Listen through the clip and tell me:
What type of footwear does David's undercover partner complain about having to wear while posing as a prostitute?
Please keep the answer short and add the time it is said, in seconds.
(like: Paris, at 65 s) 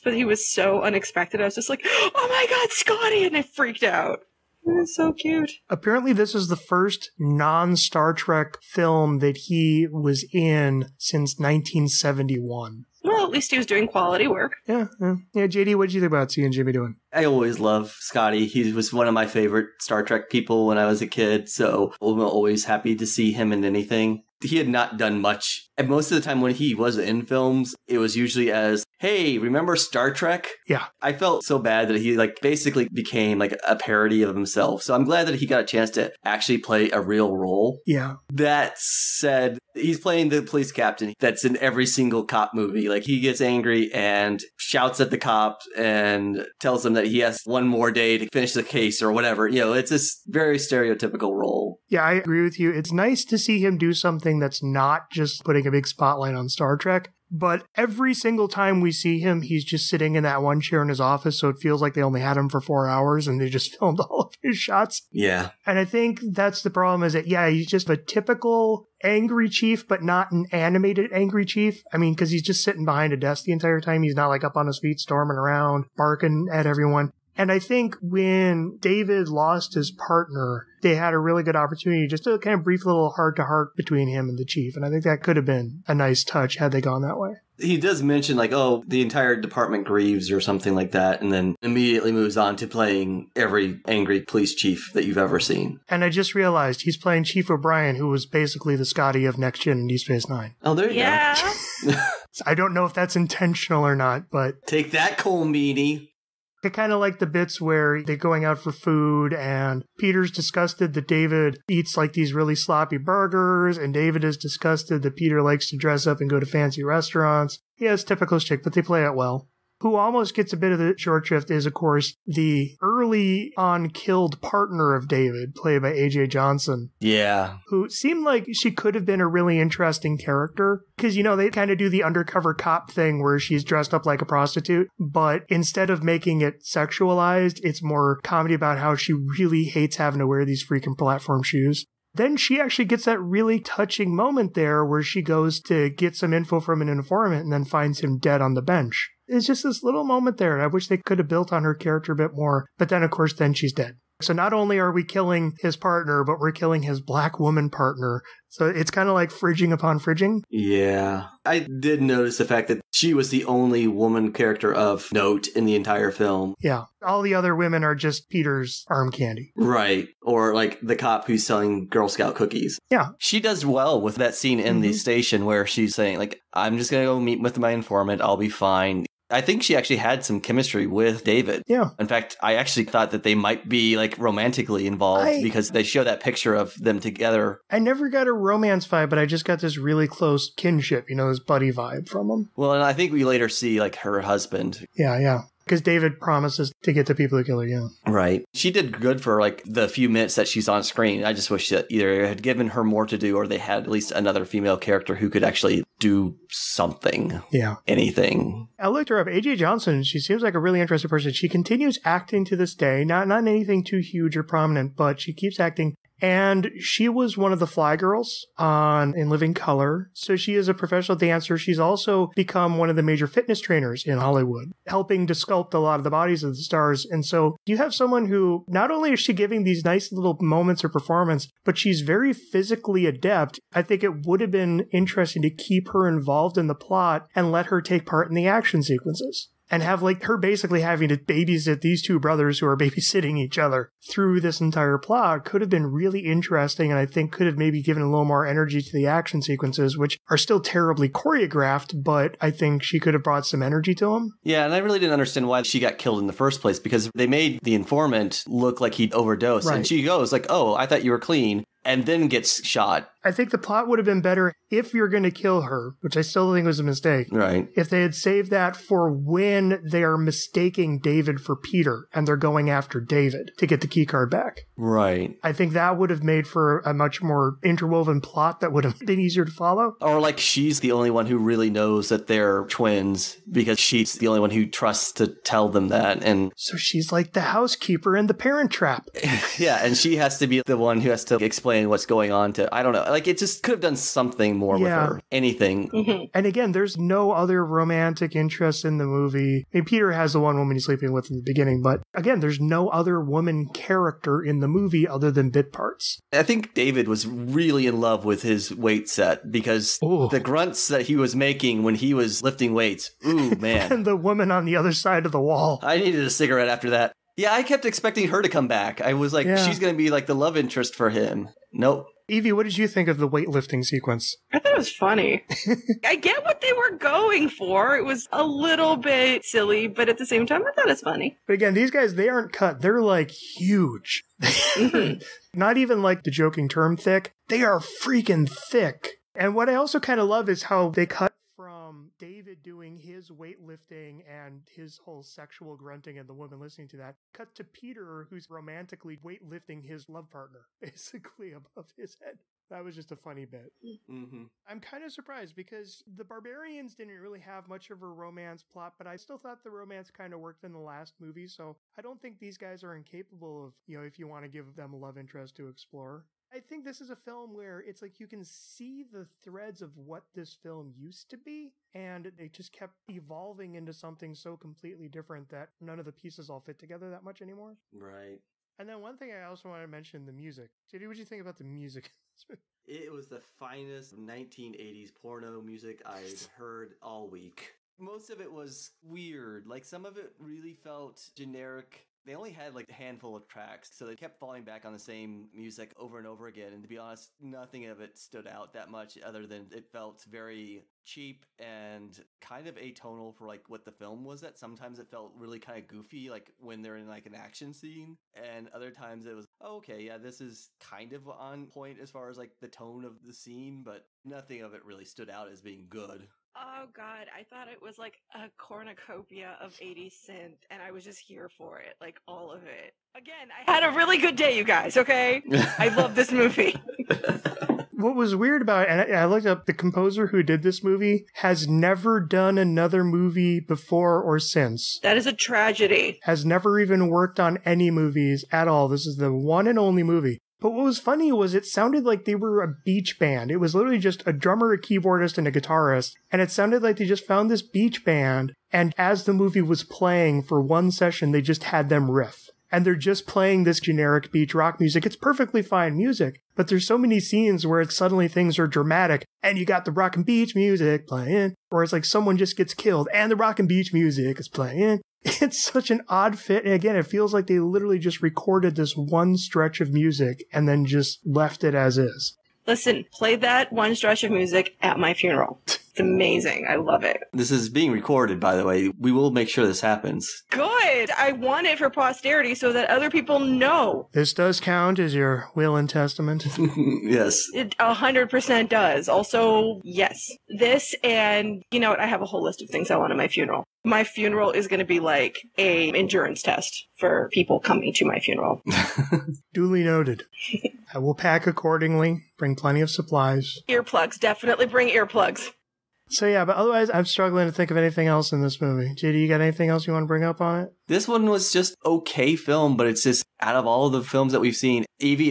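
platform shoes, at 140 s.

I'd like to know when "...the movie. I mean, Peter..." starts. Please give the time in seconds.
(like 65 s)
298 s.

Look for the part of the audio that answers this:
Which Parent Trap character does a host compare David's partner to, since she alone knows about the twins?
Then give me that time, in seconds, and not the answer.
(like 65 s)
287 s.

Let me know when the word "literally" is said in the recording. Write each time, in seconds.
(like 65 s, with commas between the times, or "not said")
443 s, 467 s.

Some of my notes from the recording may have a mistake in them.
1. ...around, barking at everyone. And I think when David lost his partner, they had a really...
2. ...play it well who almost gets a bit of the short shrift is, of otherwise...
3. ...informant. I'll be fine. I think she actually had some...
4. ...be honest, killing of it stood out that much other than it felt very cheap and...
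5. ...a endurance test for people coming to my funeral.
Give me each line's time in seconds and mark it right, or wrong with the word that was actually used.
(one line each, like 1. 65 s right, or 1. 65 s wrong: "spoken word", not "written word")
1. 75 s right
2. 118 s wrong: "course", not "otherwise"
3. 177 s right
4. 396 s wrong: "nothing", not "killing"
5. 495 s right.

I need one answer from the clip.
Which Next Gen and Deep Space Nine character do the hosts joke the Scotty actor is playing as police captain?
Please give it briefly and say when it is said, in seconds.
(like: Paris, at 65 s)
Chief O'Brien, at 97 s.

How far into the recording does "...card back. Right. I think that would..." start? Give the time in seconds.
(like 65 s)
274 s.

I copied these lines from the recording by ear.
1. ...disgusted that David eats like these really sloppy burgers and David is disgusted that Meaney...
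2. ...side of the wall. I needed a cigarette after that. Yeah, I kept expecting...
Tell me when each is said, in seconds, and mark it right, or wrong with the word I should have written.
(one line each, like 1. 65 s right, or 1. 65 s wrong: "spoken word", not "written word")
1. 110 s wrong: "Peter", not "Meaney"
2. 314 s right.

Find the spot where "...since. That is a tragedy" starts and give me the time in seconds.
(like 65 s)
434 s.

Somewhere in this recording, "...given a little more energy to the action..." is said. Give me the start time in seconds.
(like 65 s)
247 s.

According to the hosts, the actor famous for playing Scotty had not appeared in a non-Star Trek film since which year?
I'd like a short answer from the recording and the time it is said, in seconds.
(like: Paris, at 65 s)
1971, at 11 s.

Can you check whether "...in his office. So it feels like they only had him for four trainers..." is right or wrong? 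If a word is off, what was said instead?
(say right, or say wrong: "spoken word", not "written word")
wrong: "hours", not "trainers".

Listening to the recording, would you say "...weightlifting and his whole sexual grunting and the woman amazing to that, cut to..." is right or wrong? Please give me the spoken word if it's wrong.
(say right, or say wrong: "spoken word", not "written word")
wrong: "listening", not "amazing".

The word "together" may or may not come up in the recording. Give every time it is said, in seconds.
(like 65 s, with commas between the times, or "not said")
186 s, 376 s.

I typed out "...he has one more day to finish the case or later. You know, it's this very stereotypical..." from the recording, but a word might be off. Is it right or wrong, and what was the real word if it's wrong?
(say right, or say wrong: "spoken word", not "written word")
wrong: "whatever", not "later".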